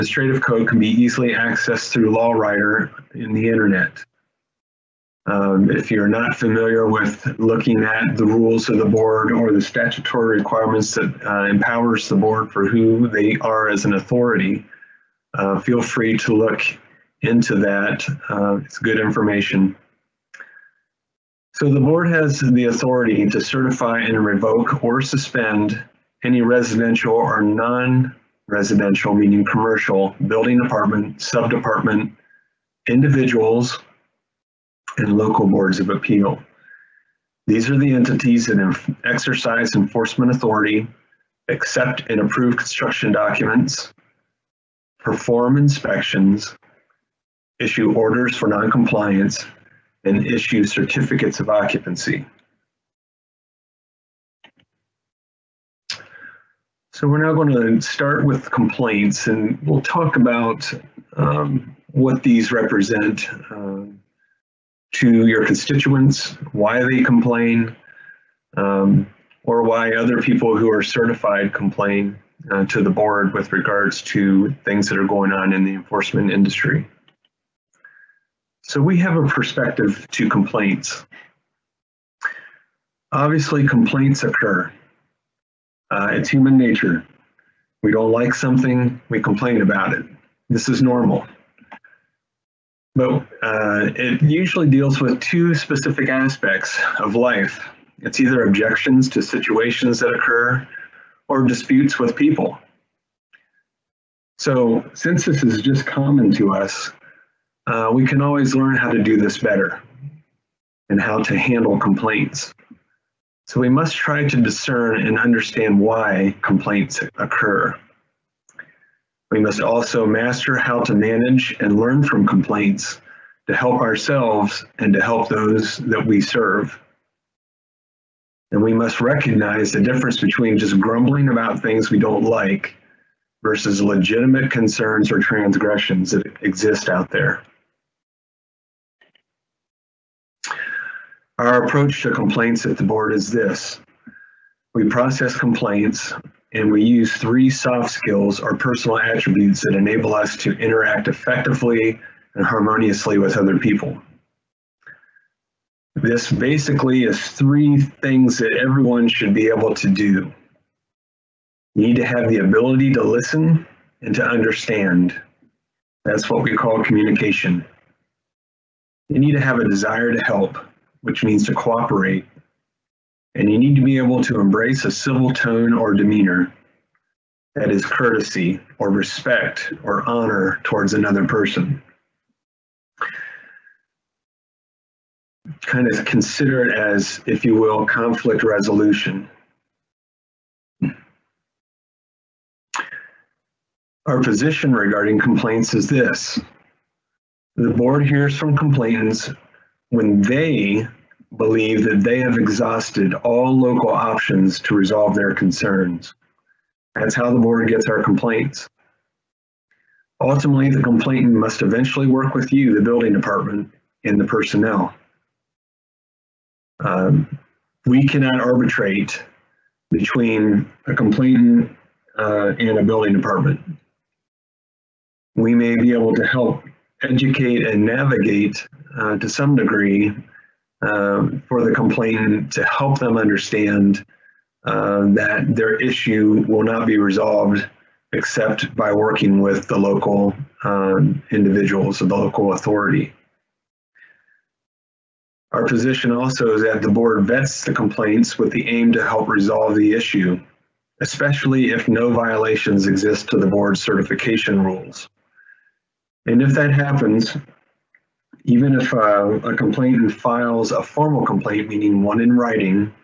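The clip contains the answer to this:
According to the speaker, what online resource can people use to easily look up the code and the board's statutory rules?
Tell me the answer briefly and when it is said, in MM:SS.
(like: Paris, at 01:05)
LAWriter, at 00:02.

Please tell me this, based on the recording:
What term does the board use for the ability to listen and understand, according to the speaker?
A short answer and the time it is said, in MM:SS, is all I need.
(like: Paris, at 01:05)
communication, at 02:46.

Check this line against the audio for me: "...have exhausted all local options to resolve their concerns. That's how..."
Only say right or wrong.
right.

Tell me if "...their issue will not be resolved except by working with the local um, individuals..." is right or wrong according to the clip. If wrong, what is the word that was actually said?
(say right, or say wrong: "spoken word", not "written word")
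right.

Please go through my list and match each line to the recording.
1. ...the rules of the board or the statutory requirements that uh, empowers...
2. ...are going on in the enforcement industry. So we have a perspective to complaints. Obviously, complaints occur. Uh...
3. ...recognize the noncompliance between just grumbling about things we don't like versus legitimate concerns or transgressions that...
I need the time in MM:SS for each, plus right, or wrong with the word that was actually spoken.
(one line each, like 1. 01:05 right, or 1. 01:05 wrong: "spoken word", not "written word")
1. 00:08 right
2. 01:14 right
3. 02:09 wrong: "difference", not "noncompliance".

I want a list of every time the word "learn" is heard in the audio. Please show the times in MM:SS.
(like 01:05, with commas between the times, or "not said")
01:48, 02:01.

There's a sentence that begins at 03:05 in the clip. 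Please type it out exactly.
kind of consider it as, if you will, conflict resolution.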